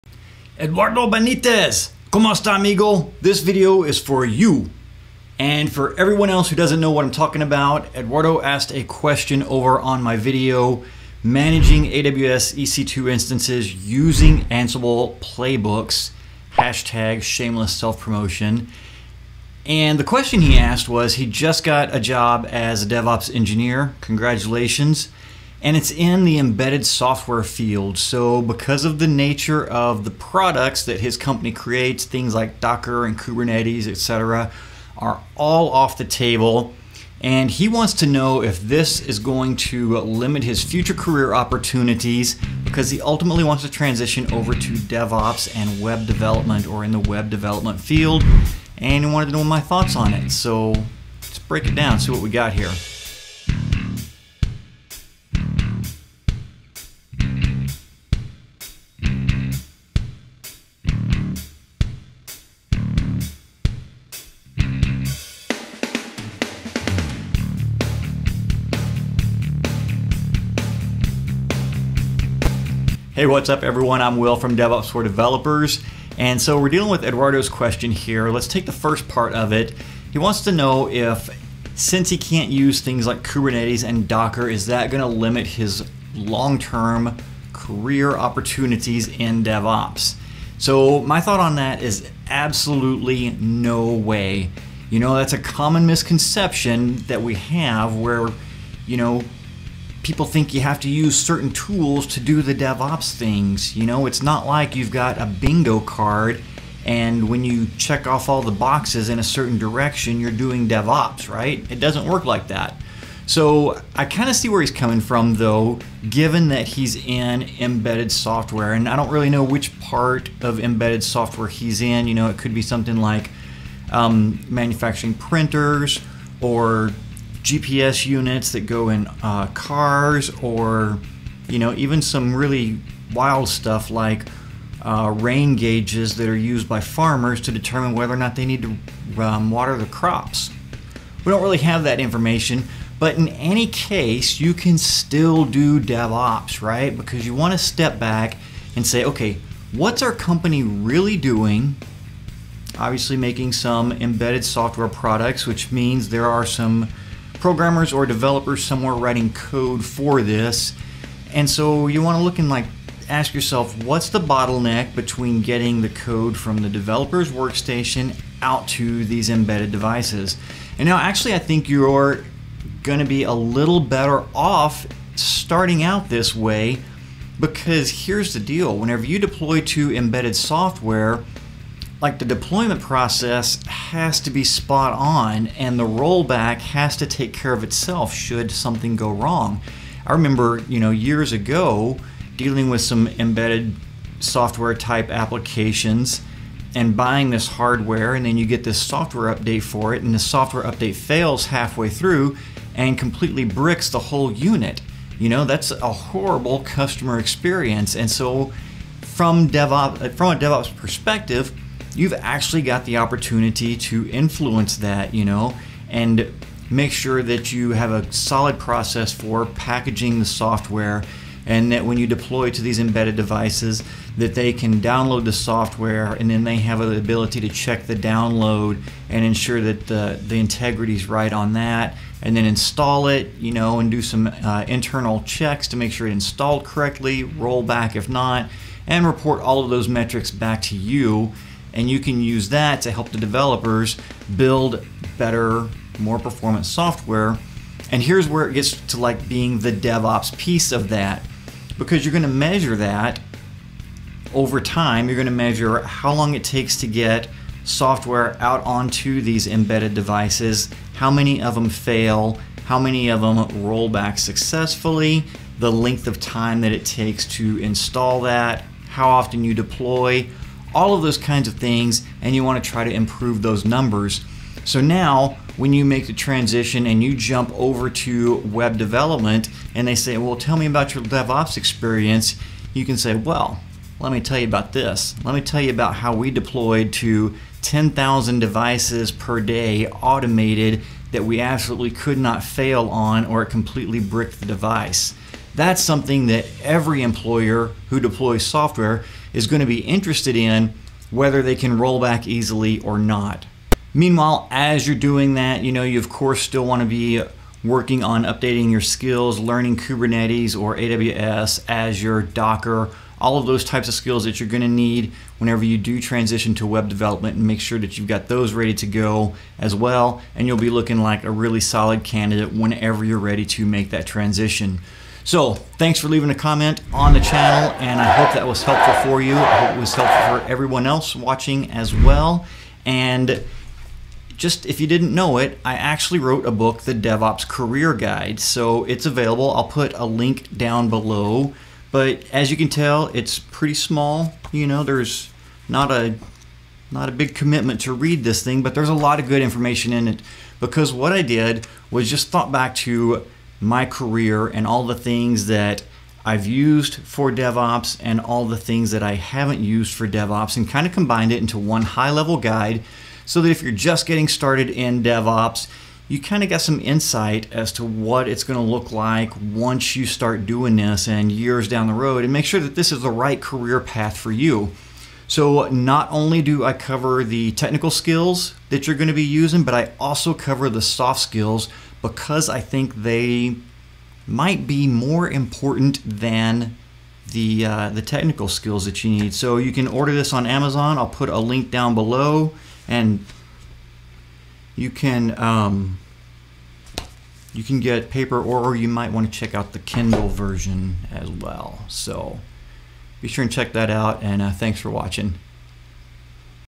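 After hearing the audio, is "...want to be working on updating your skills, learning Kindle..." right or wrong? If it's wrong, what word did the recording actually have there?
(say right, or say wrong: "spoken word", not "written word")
wrong: "Kubernetes", not "Kindle".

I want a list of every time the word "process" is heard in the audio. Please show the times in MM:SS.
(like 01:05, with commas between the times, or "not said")
03:02, 03:38.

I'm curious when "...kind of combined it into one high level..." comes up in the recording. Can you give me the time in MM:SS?
06:00.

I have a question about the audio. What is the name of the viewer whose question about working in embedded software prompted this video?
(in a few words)
Eduardo Benitez.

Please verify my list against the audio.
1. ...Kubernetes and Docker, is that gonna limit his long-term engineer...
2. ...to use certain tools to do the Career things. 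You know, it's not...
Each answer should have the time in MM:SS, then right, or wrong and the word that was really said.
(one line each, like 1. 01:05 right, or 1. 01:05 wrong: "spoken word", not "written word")
1. 01:23 wrong: "career", not "engineer"
2. 01:40 wrong: "DevOps", not "Career".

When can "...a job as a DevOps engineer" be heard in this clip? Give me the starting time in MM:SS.
00:21.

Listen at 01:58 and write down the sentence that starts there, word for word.
And I don't really know which part of embedded software he's in.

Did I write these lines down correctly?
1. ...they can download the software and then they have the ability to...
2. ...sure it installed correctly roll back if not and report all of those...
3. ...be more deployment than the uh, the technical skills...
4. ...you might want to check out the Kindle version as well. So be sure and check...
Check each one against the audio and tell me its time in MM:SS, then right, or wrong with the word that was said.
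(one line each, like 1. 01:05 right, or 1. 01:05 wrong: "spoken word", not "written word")
1. 03:44 right
2. 03:55 right
3. 06:24 wrong: "important", not "deployment"
4. 06:38 right.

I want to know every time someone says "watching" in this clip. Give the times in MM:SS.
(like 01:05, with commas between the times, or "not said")
05:31, 06:44.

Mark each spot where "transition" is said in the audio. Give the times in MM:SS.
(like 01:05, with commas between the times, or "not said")
00:43, 04:36, 05:16, 05:24.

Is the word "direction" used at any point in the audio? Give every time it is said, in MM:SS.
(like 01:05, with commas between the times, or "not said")
01:49.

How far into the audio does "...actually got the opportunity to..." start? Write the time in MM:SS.
03:32.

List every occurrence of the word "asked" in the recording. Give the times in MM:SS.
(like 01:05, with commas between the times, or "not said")
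00:08, 00:20.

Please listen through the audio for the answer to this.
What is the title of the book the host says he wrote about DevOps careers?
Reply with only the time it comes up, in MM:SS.
05:36.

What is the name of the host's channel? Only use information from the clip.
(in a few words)
DevOps for Developers.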